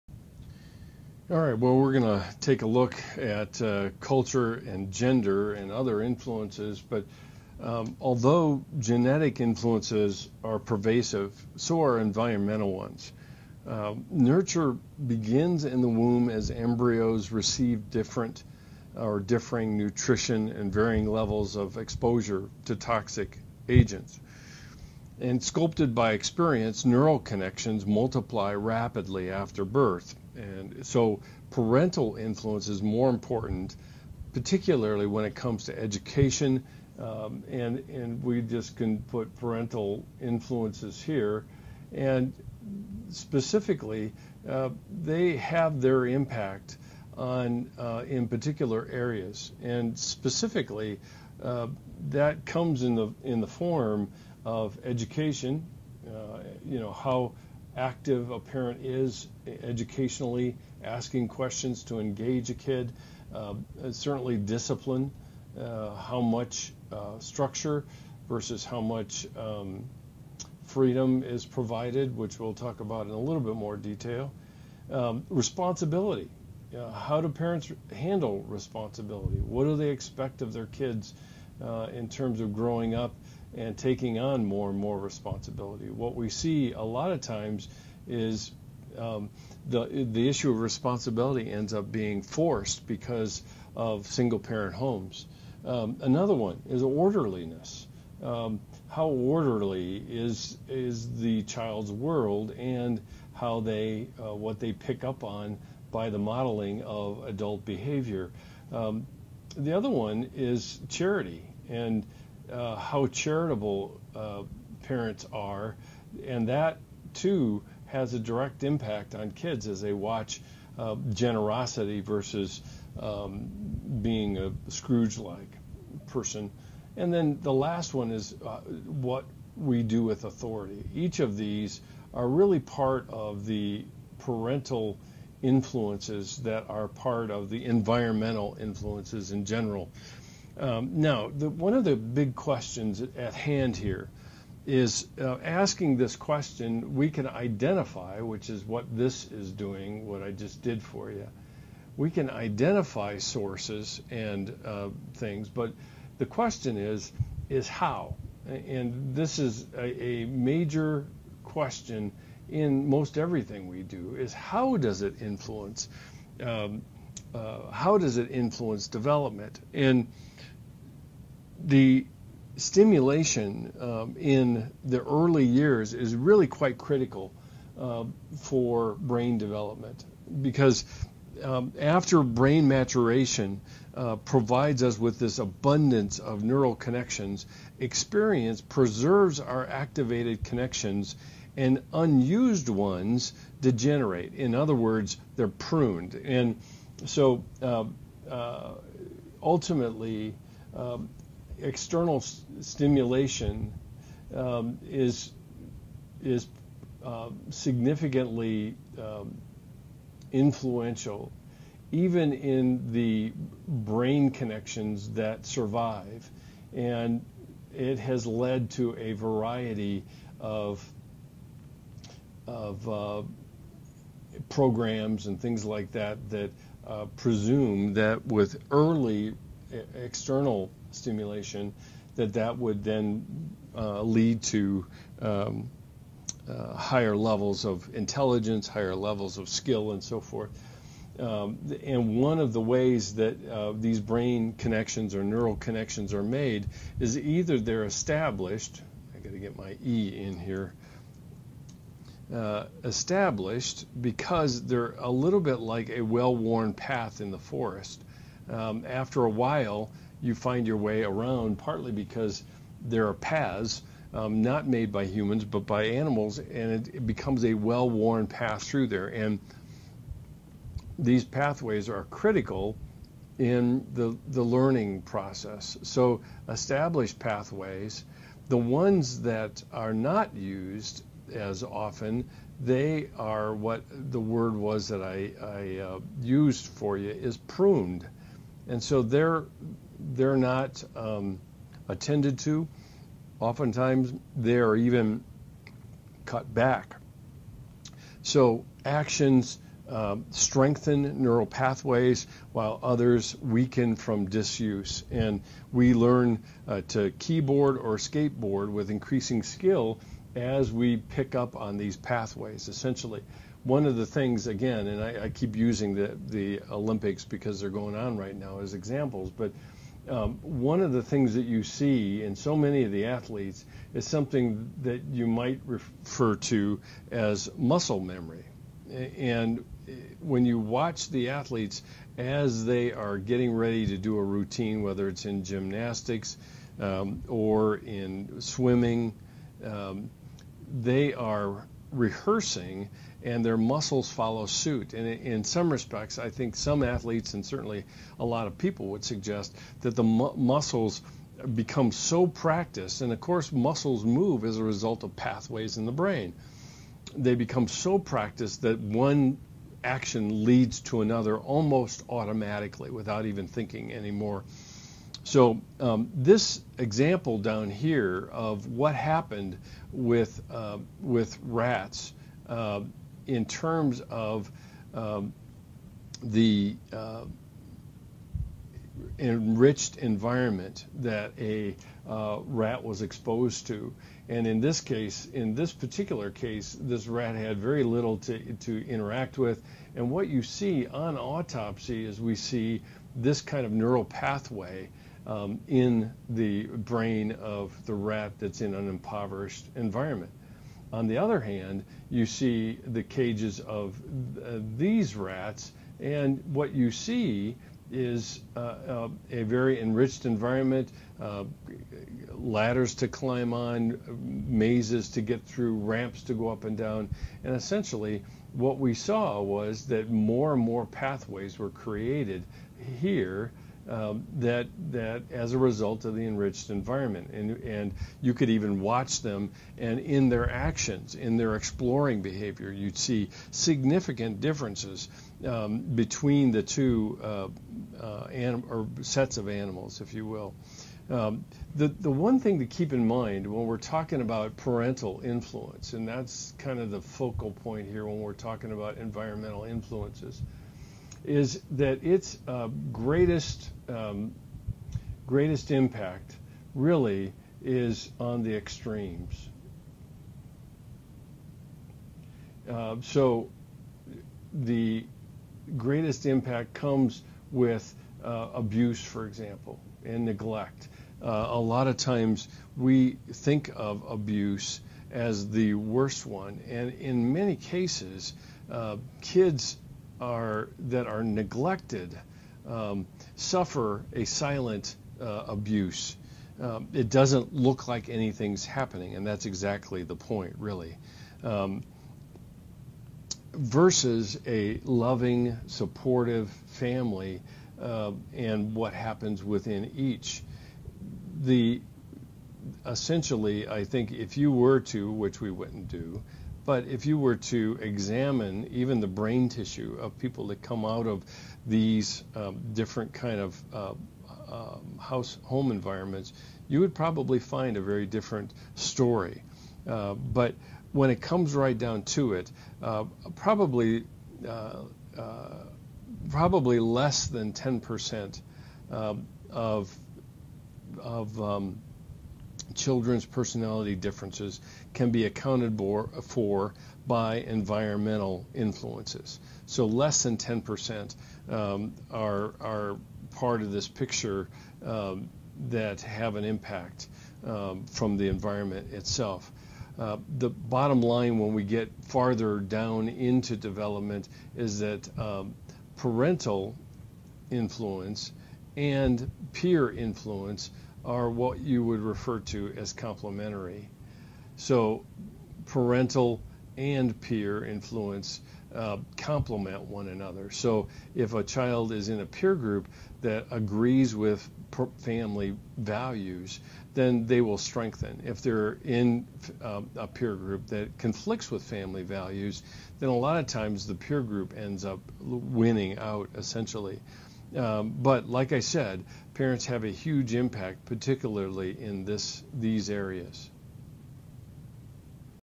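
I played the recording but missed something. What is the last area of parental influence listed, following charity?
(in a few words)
Authority.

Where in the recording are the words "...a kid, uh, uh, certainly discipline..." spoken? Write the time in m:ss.
1:02.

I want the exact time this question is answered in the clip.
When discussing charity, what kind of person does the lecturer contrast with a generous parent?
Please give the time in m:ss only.
2:04.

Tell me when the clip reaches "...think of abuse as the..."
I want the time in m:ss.
7:53.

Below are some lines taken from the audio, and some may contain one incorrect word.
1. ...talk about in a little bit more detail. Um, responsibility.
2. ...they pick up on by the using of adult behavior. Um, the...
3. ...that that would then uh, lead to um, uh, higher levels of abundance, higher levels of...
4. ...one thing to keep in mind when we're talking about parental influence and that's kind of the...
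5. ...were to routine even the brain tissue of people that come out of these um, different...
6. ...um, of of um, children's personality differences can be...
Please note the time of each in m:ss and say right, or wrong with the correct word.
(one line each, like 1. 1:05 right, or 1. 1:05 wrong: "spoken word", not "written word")
1. 1:12 right
2. 1:44 wrong: "modeling", not "using"
3. 3:52 wrong: "intelligence", not "abundance"
4. 7:22 right
5. 8:27 wrong: "examine", not "routine"
6. 8:48 right.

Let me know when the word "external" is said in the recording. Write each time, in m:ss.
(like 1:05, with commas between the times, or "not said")
3:21, 3:49.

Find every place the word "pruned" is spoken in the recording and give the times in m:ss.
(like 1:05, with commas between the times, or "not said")
3:15, 4:47.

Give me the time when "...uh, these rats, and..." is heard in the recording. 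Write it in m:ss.
6:44.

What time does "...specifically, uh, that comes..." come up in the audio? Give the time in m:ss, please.
0:49.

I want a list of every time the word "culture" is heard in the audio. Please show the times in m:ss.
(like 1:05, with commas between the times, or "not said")
0:04.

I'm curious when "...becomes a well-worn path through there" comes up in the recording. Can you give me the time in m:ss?
4:27.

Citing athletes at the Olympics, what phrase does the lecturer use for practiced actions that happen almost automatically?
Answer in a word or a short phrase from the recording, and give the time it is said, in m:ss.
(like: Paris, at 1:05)
Muscle memory, at 5:27.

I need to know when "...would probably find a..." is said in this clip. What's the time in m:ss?
8:36.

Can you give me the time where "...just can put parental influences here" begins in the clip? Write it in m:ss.
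0:38.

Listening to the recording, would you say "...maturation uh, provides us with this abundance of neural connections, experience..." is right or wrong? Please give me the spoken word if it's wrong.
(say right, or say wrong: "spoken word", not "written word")
right.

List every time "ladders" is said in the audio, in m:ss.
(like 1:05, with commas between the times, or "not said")
6:52.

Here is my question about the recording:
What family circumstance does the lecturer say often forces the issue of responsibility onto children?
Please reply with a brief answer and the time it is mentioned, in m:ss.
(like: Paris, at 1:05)
Single parent homes, at 1:34.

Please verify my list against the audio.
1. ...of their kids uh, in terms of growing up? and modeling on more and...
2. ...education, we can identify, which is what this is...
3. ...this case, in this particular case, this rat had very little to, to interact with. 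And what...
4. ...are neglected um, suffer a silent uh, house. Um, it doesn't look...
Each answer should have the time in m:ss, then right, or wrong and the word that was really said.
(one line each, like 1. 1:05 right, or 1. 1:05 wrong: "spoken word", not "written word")
1. 1:20 wrong: "taking", not "modeling"
2. 2:26 wrong: "question", not "education"
3. 6:24 right
4. 8:01 wrong: "abuse", not "house".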